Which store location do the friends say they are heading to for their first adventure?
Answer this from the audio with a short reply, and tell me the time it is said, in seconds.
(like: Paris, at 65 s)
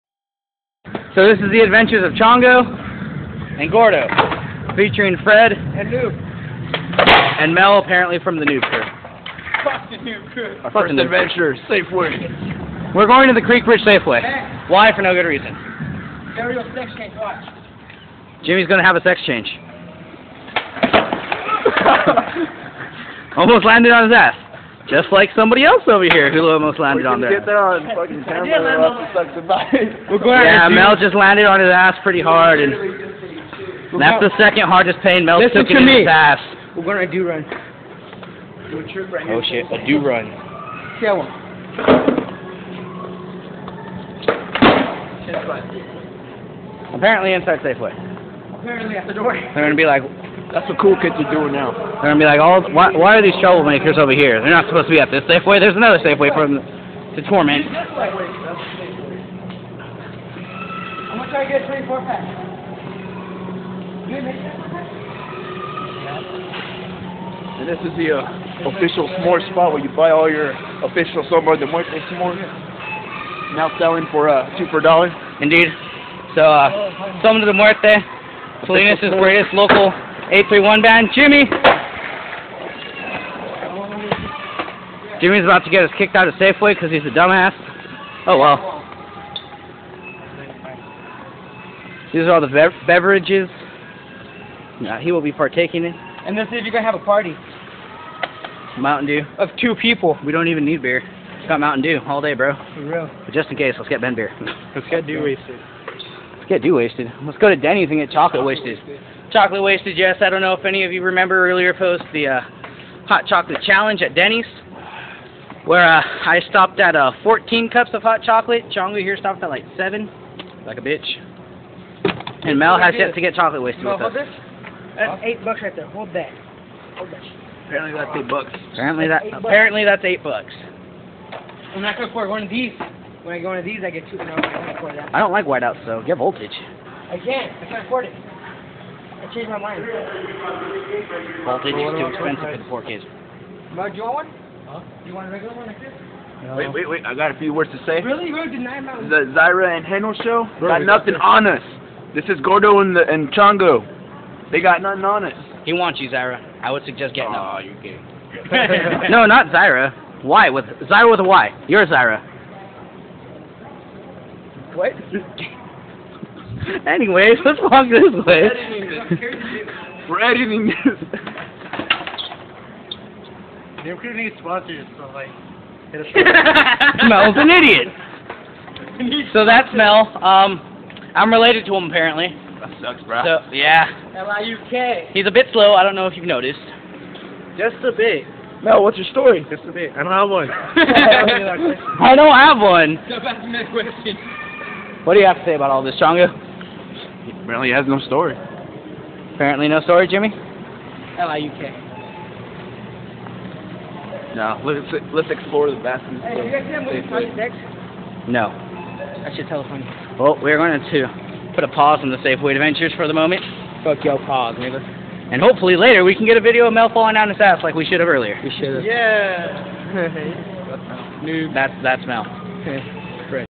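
Creek Bridge Safeway, at 13 s.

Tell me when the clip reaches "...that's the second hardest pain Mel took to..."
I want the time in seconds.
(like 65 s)
34 s.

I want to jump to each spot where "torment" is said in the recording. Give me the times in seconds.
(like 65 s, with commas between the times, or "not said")
57 s.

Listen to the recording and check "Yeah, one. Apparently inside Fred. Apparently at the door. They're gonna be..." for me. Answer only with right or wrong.
wrong.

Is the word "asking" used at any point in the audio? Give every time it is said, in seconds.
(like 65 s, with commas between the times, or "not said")
193 s.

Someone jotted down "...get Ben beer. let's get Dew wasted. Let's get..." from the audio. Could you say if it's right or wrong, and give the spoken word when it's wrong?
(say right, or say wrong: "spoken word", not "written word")
right.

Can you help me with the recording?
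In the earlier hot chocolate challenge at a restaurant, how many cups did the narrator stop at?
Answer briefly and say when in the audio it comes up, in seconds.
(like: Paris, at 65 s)
14, at 117 s.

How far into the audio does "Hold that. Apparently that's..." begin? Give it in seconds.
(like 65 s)
126 s.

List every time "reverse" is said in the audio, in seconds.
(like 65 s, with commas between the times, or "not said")
not said.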